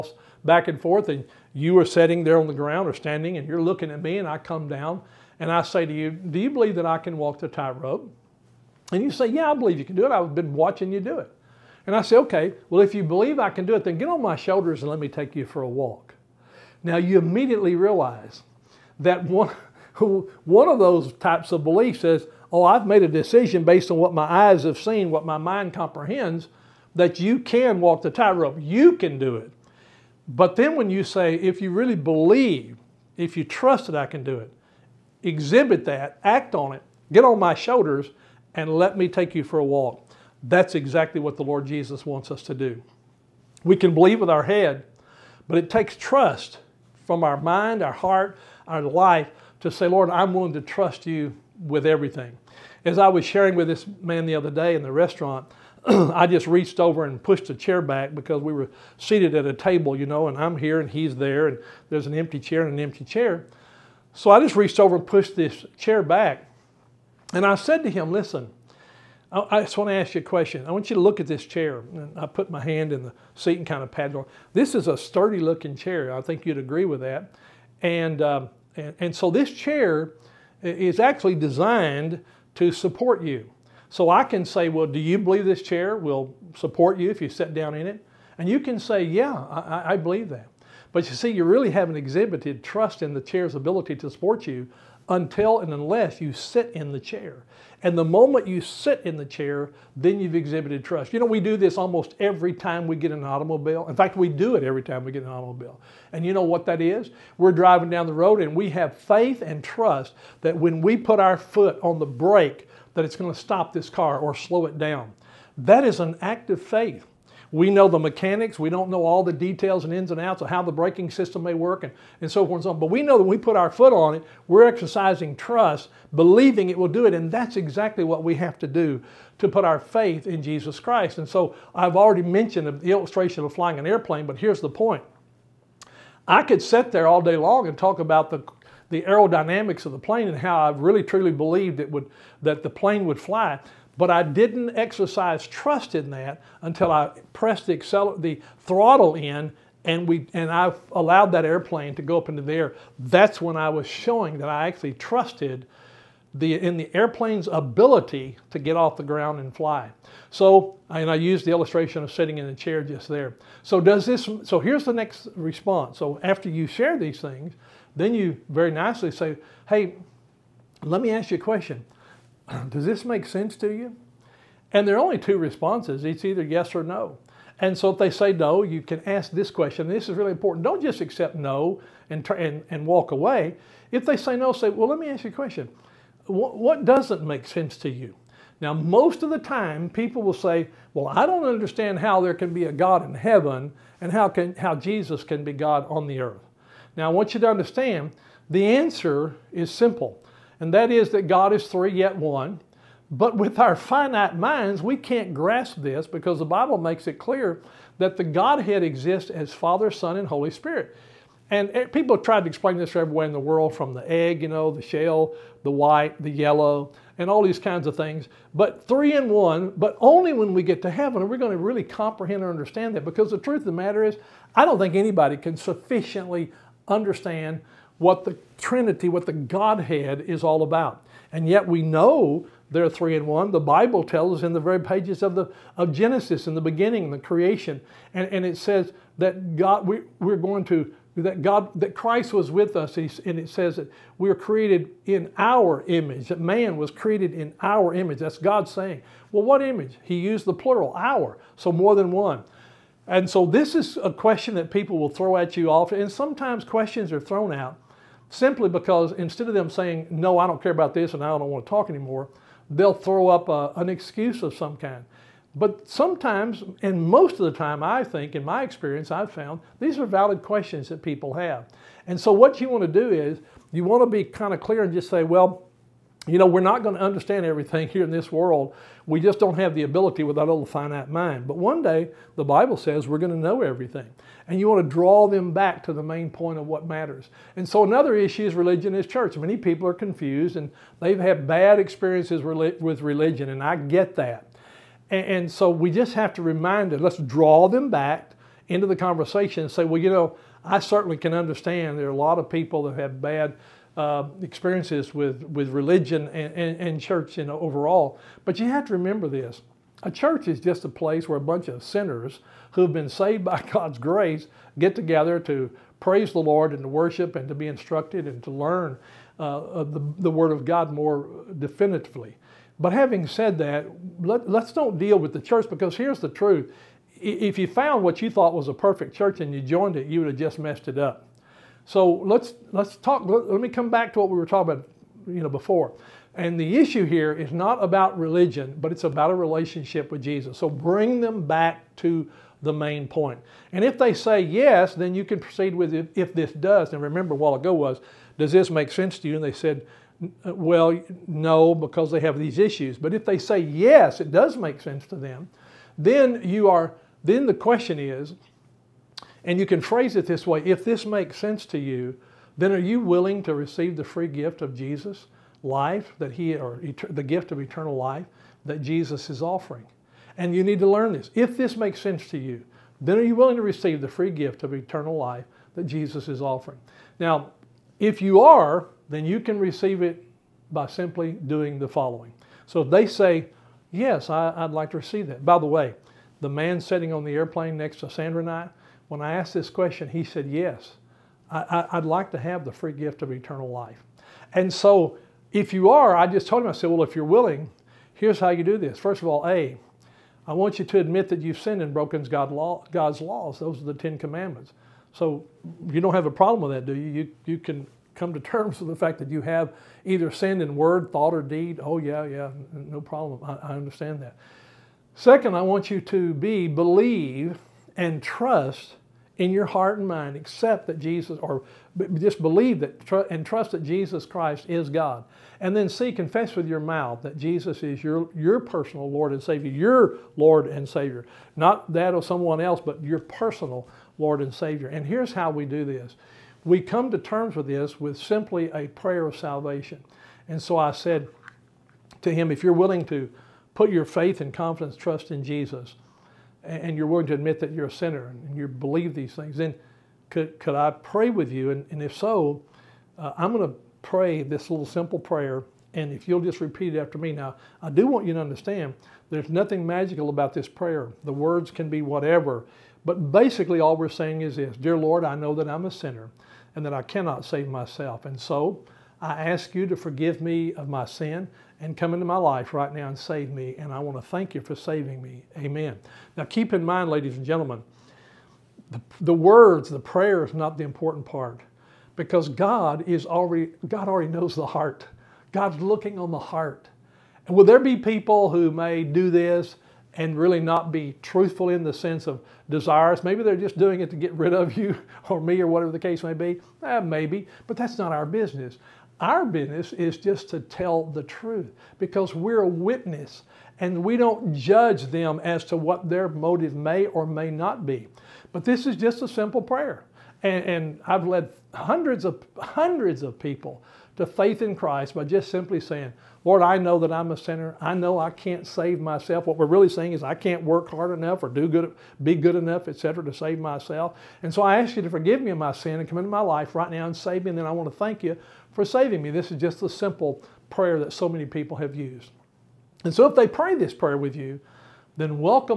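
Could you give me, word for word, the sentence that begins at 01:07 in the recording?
And I said to him, Listen, I just want to ask you a question.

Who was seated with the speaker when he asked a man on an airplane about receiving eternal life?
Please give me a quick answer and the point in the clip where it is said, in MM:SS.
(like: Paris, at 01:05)
Sandra, at 06:28.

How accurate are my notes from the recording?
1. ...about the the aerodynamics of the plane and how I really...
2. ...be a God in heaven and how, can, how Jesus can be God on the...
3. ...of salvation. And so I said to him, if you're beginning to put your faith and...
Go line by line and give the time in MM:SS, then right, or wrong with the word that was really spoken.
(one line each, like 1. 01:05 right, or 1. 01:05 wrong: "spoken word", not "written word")
1. 02:17 right
2. 03:12 right
3. 07:19 wrong: "willing", not "beginning".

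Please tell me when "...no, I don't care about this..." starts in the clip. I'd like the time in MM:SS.
04:20.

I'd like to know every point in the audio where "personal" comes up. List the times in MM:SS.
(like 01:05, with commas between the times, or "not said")
07:08, 07:13.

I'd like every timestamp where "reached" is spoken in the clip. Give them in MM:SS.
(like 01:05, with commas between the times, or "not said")
00:56, 01:04.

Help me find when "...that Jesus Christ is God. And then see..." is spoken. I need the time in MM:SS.
07:03.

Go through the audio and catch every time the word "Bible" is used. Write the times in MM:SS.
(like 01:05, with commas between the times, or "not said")
03:26, 03:53, 04:42.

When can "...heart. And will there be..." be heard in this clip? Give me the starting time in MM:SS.
08:06.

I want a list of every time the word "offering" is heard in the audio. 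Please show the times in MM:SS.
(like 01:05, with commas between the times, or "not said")
06:09, 06:16.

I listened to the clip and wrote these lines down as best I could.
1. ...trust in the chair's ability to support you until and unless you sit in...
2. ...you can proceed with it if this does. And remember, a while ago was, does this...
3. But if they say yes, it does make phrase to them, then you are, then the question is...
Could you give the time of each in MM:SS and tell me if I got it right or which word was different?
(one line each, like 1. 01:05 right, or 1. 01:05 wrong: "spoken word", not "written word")
1. 01:32 right
2. 05:45 right
3. 05:52 wrong: "sense", not "phrase".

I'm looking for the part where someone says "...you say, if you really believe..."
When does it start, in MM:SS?
00:30.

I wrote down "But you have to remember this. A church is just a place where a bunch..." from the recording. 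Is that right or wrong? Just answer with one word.
right.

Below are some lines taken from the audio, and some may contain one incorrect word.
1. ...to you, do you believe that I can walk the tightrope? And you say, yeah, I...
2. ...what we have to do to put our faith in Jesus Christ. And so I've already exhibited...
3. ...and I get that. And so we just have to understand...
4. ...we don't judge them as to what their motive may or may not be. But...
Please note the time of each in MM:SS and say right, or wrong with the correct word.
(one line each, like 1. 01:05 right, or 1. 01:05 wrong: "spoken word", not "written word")
1. 00:05 right
2. 02:08 wrong: "mentioned", not "exhibited"
3. 04:53 wrong: "remind", not "understand"
4. 08:24 right.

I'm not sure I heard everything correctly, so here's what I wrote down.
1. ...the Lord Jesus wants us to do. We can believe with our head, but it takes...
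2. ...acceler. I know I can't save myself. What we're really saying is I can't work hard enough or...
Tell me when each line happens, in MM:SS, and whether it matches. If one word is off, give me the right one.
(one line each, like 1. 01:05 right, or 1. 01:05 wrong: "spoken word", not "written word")
1. 00:41 right
2. 08:37 wrong: "sinner", not "acceler".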